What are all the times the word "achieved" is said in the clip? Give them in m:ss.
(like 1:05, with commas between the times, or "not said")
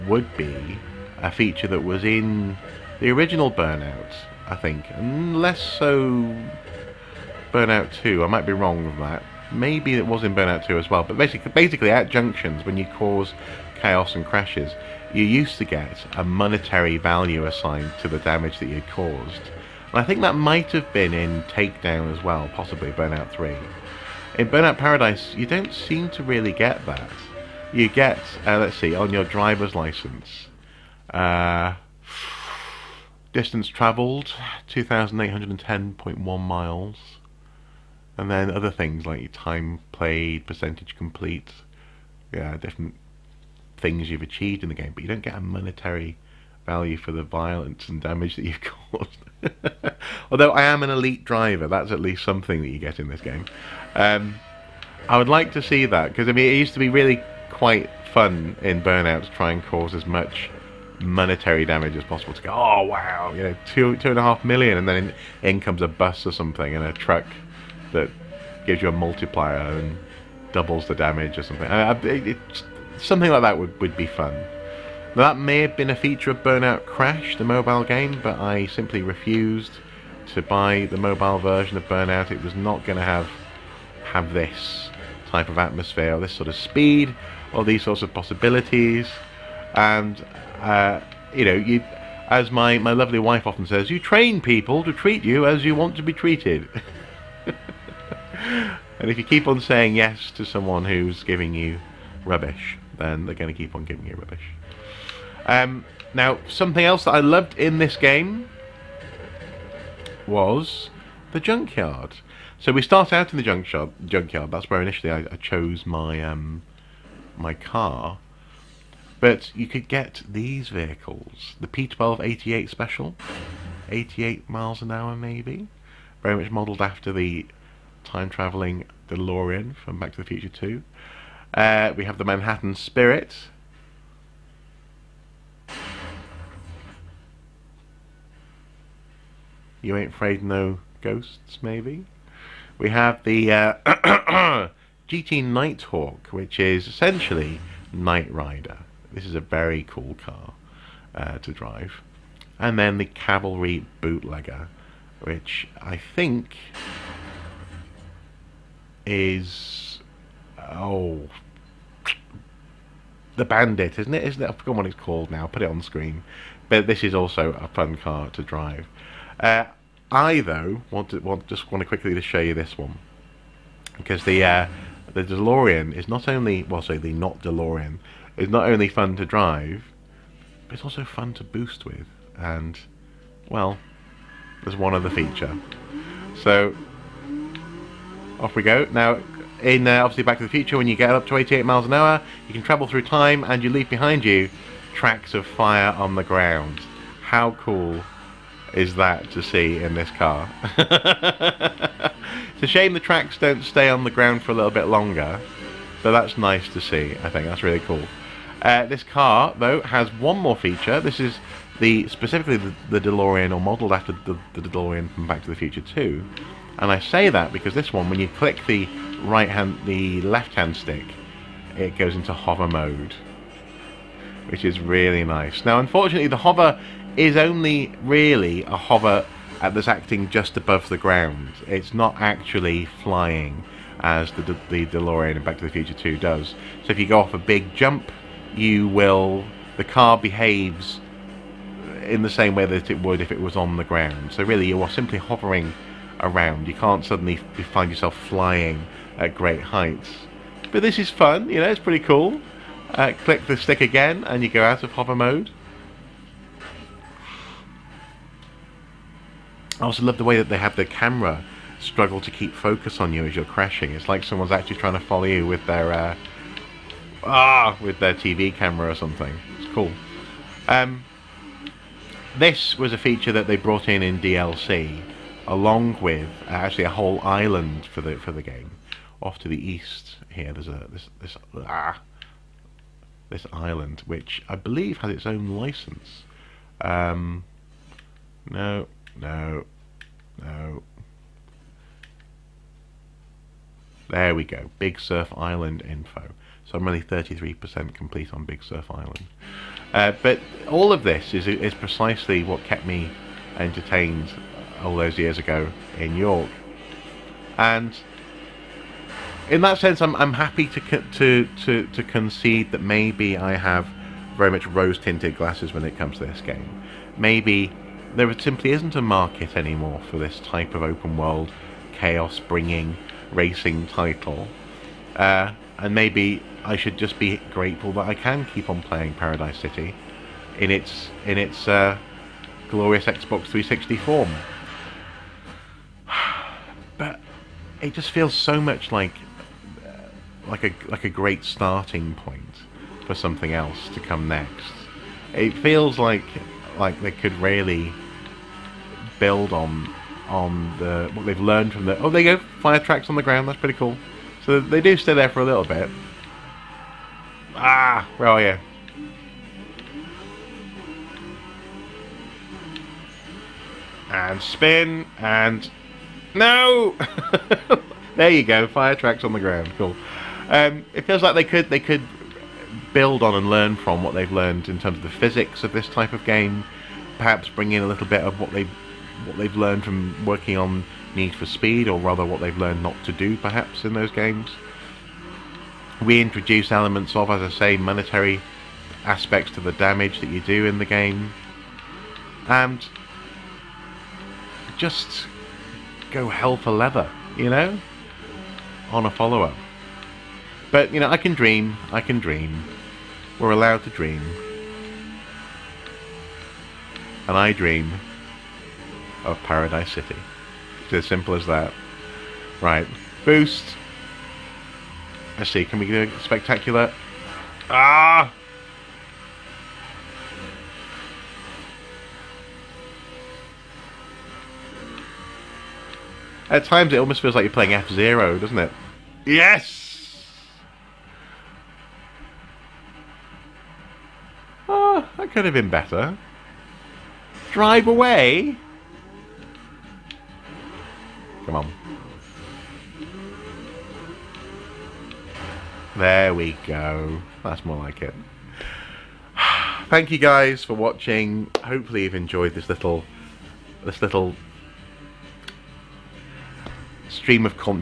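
0:44.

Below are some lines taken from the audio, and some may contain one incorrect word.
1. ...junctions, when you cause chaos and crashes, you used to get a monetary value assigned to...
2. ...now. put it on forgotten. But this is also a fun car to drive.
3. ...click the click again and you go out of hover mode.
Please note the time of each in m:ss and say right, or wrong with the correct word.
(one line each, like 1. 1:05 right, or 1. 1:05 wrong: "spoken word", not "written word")
1. 0:12 right
2. 2:45 wrong: "screen", not "forgotten"
3. 4:13 wrong: "stick", not "click".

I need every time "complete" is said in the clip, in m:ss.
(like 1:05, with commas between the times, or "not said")
0:40, 4:57.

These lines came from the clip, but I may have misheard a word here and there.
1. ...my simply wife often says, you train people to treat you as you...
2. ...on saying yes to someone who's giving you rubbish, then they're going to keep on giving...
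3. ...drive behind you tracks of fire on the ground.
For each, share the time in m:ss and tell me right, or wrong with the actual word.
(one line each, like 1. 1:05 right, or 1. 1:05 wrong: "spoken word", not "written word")
1. 1:32 wrong: "lovely", not "simply"
2. 1:39 right
3. 3:13 wrong: "leave", not "drive".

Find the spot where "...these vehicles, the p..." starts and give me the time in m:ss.
2:00.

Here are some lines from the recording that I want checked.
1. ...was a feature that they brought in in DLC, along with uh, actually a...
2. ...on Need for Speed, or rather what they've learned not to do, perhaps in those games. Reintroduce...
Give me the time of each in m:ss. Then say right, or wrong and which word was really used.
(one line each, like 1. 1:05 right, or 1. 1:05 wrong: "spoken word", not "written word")
1. 4:32 right
2. 6:20 right.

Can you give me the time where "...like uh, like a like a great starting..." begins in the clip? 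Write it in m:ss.
5:38.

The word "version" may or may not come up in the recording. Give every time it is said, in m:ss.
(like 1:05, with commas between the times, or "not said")
1:21.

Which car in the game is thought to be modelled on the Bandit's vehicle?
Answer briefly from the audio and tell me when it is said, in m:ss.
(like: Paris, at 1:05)
Cavalry Bootlegger, at 2:33.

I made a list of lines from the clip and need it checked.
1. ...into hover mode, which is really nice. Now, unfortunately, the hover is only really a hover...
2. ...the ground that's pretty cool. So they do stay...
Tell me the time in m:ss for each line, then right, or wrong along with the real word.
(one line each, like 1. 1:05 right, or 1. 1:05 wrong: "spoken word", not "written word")
1. 3:42 right
2. 5:53 right.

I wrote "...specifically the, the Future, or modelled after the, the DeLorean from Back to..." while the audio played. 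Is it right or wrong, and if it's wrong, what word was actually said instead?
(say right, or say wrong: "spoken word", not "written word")
wrong: "DeLorean", not "Future".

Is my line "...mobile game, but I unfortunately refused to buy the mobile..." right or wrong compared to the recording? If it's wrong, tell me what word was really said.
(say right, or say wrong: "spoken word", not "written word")
wrong: "simply", not "unfortunately".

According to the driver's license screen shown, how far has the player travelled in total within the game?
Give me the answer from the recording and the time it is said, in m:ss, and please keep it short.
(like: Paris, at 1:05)
2,810.1 miles, at 0:34.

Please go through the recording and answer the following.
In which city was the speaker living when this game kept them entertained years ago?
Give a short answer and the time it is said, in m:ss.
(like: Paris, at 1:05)
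York, at 5:06.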